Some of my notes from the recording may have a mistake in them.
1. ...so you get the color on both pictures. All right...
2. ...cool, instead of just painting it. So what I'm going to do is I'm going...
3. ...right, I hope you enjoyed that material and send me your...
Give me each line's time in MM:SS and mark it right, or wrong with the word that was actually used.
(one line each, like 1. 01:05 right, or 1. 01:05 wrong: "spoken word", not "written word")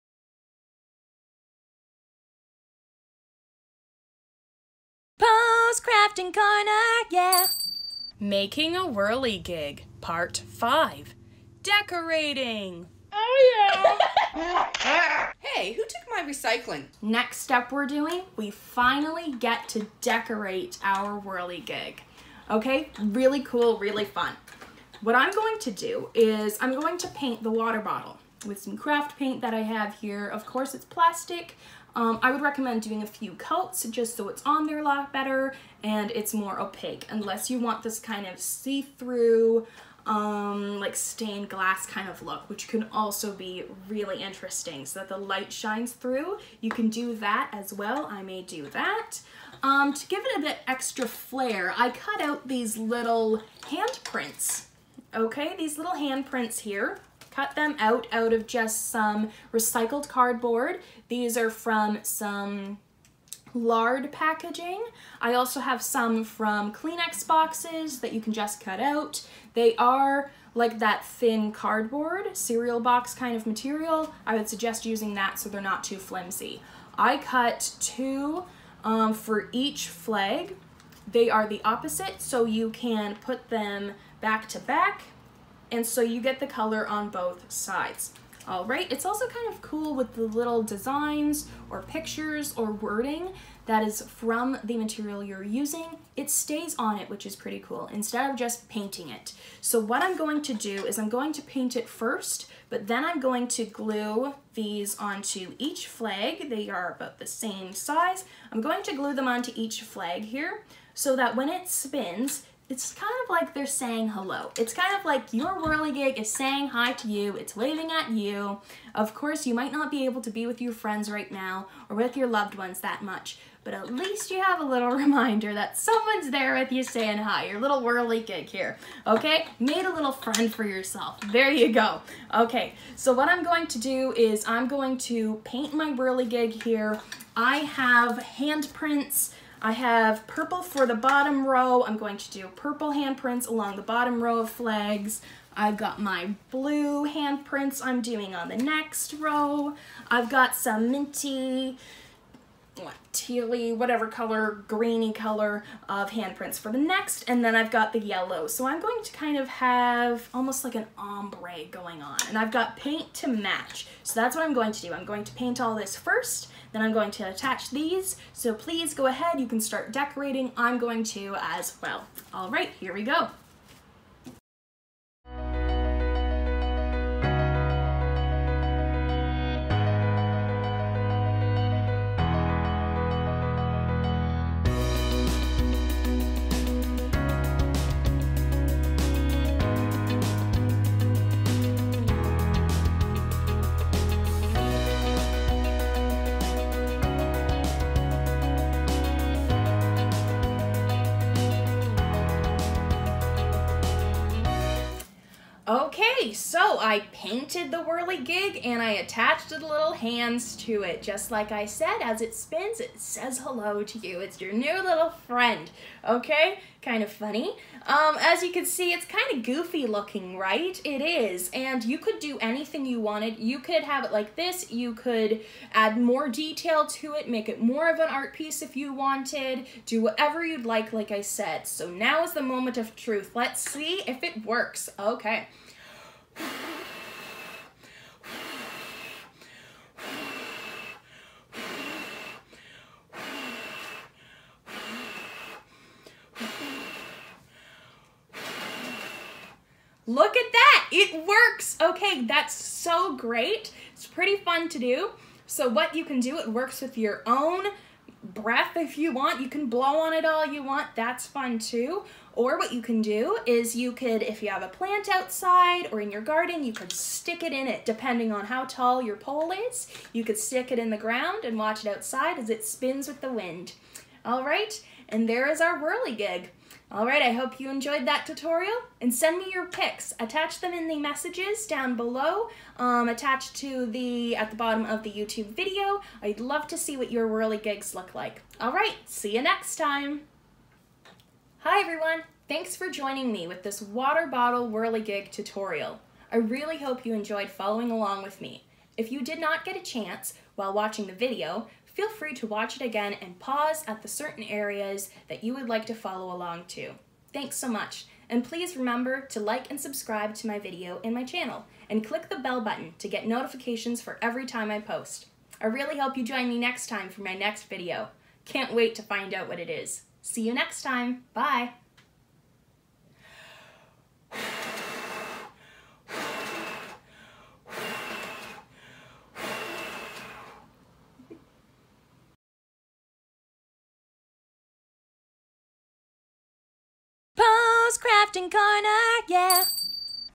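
1. 01:25 wrong: "sides", not "pictures"
2. 01:37 right
3. 04:37 wrong: "tutorial", not "material".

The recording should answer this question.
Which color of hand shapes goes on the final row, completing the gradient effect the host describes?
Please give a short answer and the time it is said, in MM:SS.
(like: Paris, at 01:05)
Yellow, at 02:37.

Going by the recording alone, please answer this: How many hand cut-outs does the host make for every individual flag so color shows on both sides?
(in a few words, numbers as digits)
2.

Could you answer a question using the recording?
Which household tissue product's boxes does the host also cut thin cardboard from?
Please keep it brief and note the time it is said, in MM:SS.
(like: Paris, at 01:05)
Kleenex boxes, at 01:06.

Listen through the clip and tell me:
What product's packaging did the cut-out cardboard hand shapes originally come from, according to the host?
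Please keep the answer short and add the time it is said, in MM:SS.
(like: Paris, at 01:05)
Lard packaging, at 01:03.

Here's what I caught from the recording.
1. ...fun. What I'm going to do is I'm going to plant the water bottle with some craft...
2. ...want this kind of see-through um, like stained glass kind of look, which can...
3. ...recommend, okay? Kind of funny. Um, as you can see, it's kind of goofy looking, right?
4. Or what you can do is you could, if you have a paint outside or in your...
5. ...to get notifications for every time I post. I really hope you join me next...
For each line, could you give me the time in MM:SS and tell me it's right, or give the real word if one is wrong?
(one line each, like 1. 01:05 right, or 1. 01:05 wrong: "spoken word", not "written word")
1. 00:24 wrong: "paint", not "plant"
2. 00:37 right
3. 03:35 wrong: "friend", not "recommend"
4. 04:22 wrong: "plant", not "paint"
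5. 05:12 right.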